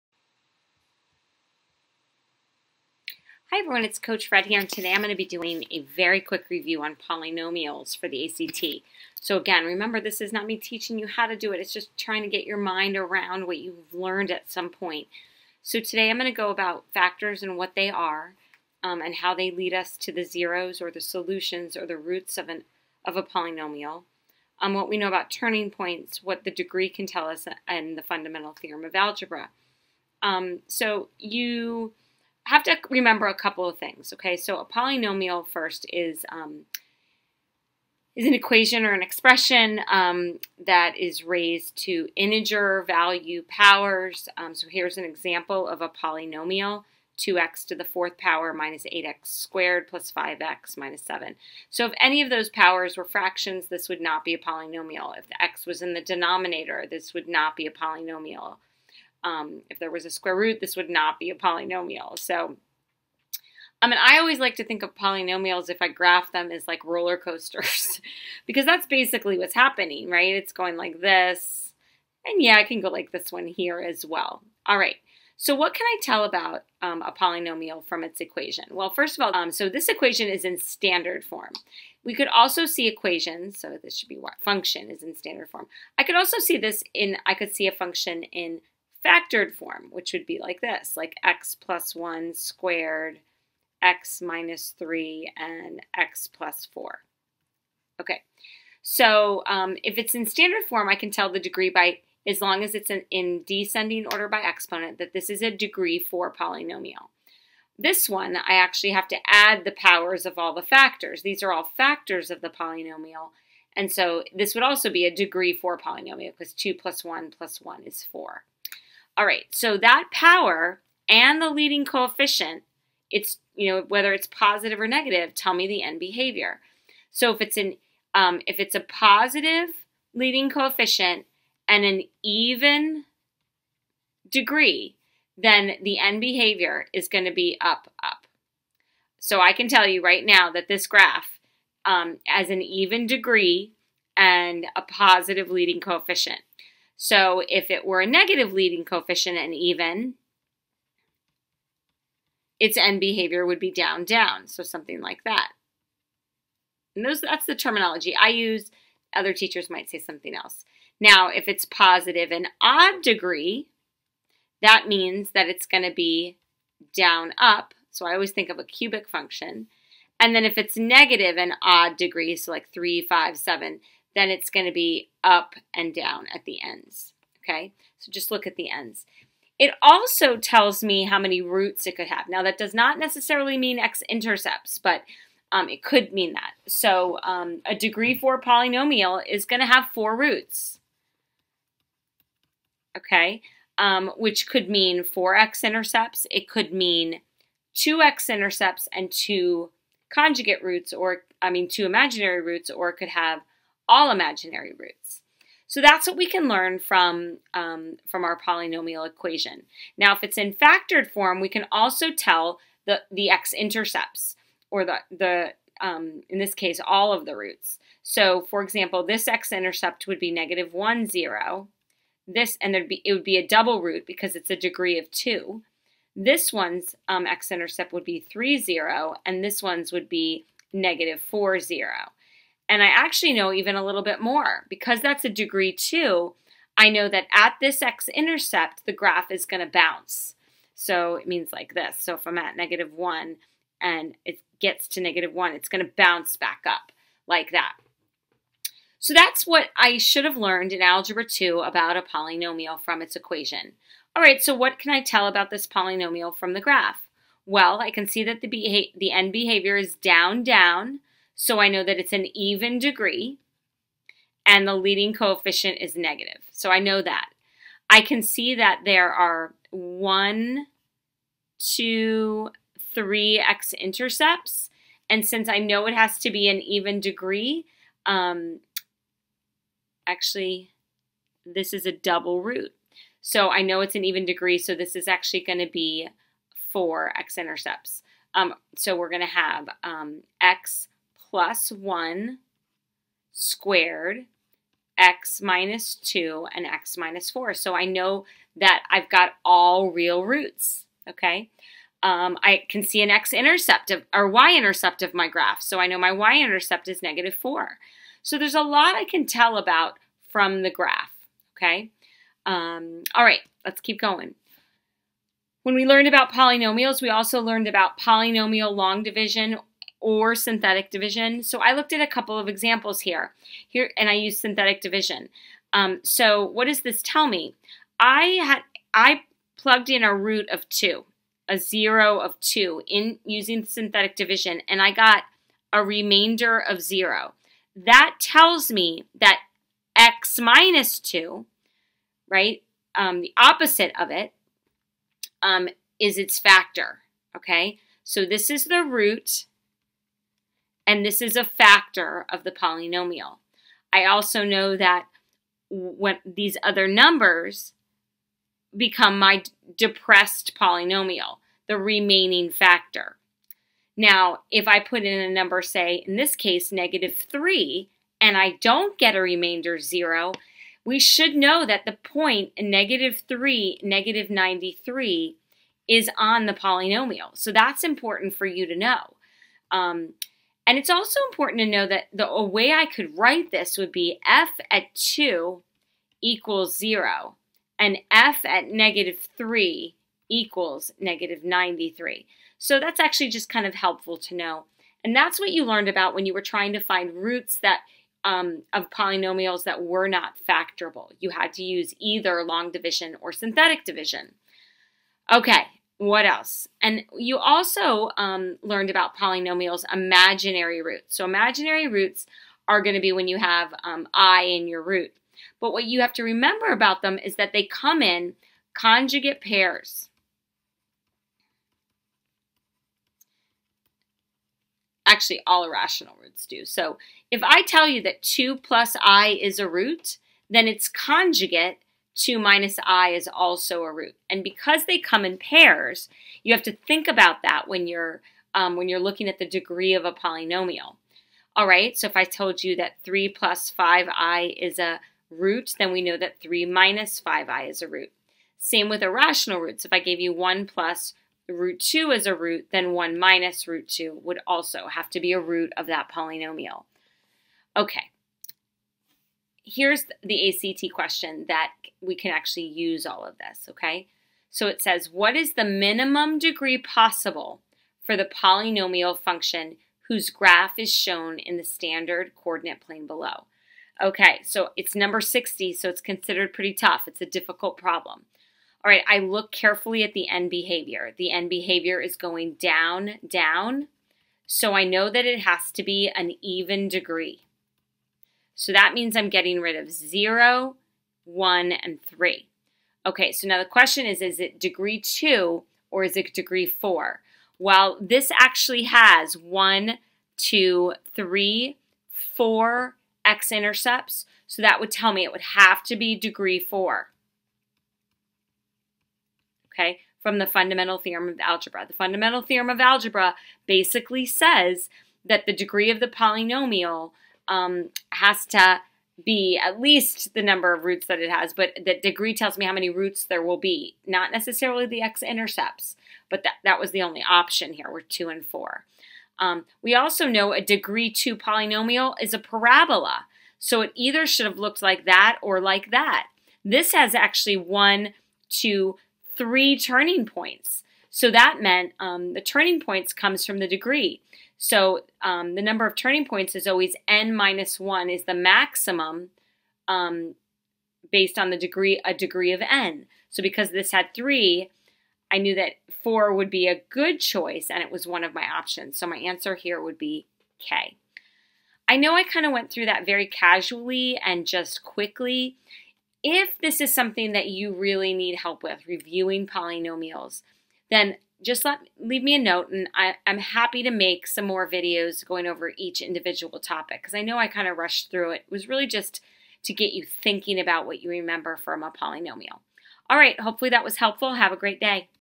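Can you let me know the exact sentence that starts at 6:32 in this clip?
So that's actually just kind of helpful to know.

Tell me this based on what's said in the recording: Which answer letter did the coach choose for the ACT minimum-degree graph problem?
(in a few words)
K.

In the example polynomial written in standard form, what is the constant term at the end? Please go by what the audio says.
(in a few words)
-7.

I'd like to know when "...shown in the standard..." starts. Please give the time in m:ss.
7:50.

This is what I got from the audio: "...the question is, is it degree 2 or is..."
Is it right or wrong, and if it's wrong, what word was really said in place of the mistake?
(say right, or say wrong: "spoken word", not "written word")
right.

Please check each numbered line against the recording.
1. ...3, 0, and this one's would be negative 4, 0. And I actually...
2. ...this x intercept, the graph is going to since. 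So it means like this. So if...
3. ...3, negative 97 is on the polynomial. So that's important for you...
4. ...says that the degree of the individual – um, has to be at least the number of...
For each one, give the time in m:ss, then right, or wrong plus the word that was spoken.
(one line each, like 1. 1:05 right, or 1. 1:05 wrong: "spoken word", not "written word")
1. 3:48 right
2. 3:57 wrong: "bounce", not "since"
3. 6:13 wrong: "93", not "97"
4. 8:34 wrong: "polynomial", not "individual".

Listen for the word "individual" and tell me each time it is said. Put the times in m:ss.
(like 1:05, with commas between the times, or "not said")
9:36.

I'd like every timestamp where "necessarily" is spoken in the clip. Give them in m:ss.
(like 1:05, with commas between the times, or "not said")
3:02, 8:44.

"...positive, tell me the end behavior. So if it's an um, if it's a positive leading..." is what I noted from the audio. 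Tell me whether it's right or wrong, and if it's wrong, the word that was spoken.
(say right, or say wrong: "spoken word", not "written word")
wrong: "negative", not "positive".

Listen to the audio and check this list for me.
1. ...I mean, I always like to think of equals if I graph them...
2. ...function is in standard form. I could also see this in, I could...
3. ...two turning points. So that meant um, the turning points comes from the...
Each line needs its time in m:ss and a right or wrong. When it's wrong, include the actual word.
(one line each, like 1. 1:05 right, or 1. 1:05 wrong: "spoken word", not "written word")
1. 1:03 wrong: "polynomials", not "equals"
2. 1:24 right
3. 8:59 wrong: "three", not "two".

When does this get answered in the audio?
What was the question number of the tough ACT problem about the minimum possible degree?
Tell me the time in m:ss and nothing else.
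7:54.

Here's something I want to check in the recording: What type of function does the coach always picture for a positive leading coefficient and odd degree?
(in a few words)
Cubic function.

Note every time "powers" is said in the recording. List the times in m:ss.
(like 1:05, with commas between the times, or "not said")
0:43, 0:48, 0:52, 1:49, 2:00.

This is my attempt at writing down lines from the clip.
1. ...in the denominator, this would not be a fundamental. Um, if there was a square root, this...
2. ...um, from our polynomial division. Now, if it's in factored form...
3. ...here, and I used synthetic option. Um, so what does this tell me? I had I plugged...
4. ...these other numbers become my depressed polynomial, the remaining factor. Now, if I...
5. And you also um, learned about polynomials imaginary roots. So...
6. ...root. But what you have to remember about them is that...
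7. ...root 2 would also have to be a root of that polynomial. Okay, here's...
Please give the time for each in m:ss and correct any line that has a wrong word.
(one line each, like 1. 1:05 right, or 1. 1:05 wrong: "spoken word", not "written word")
1. 0:55 wrong: "polynomial", not "fundamental"
2. 3:27 wrong: "equation", not "division"
3. 5:23 wrong: "division", not "option"
4. 5:56 right
5. 6:46 right
6. 6:54 right
7. 7:33 right.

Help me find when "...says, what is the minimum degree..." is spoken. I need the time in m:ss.
7:44.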